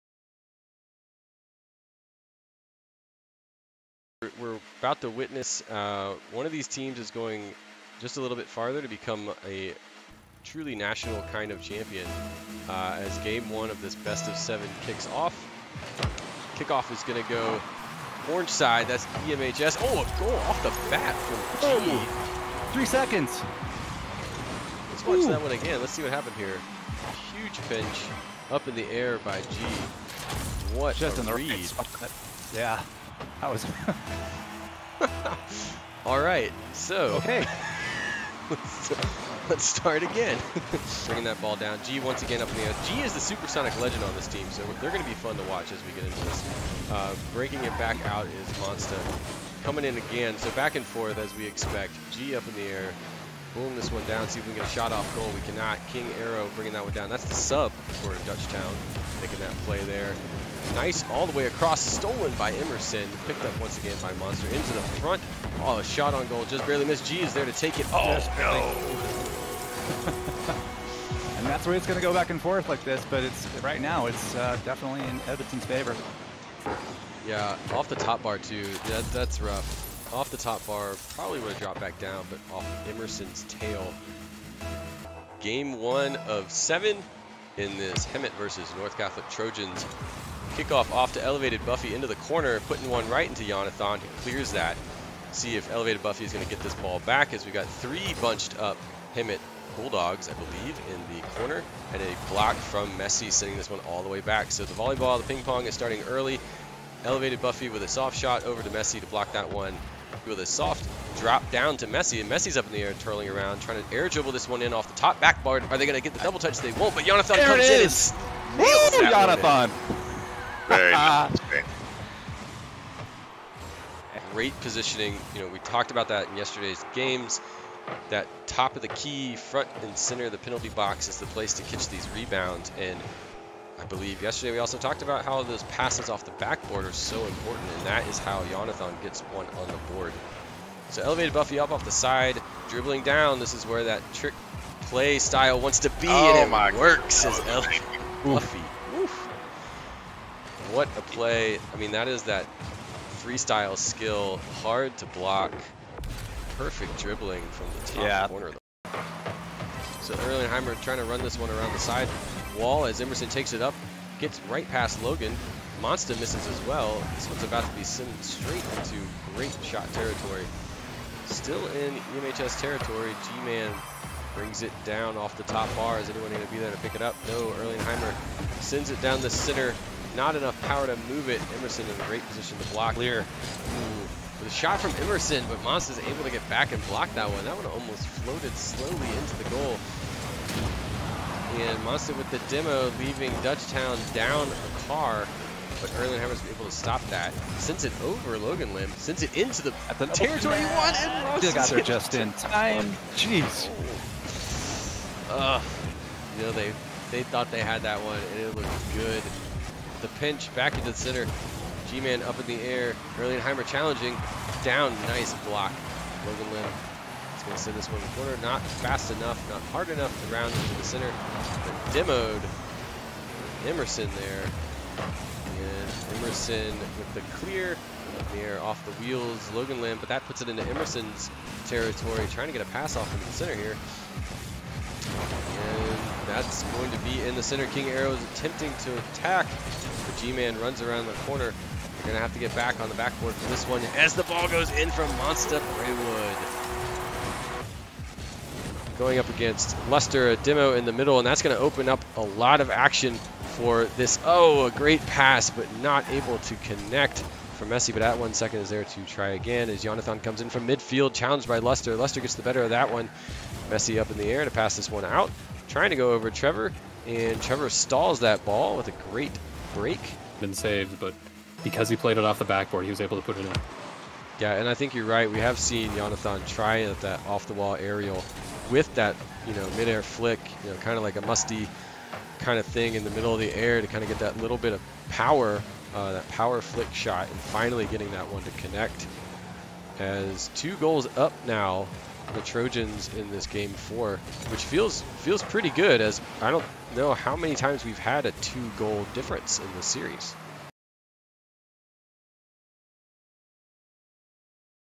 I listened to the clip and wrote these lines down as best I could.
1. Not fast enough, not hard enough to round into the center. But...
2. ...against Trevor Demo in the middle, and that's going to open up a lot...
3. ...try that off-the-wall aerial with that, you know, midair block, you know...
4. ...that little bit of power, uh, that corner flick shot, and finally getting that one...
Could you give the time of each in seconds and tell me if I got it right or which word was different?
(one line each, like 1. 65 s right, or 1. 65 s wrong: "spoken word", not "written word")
1. 218 s right
2. 249 s wrong: "Lester", not "Trevor"
3. 276 s wrong: "flick", not "block"
4. 284 s wrong: "power", not "corner".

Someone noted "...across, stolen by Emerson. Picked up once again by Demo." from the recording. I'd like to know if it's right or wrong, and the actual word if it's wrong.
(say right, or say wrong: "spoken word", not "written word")
wrong: "Monsta", not "Demo".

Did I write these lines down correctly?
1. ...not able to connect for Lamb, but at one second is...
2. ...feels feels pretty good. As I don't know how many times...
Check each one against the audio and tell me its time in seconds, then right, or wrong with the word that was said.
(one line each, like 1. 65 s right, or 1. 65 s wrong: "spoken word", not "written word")
1. 255 s wrong: "Messi", not "Lamb"
2. 294 s right.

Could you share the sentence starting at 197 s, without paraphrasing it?
Sends it over Logan Lim, sends it into the, the territory you want, and Munson got there just in time.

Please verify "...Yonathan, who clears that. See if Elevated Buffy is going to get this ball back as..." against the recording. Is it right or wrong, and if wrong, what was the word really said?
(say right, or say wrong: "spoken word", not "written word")
right.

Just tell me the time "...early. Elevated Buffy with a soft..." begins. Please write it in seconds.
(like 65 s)
106 s.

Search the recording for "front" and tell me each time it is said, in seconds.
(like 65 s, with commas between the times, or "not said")
65 s, 129 s.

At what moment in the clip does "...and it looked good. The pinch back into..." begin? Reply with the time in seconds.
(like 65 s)
208 s.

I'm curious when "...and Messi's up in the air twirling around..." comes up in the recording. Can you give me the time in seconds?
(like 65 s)
112 s.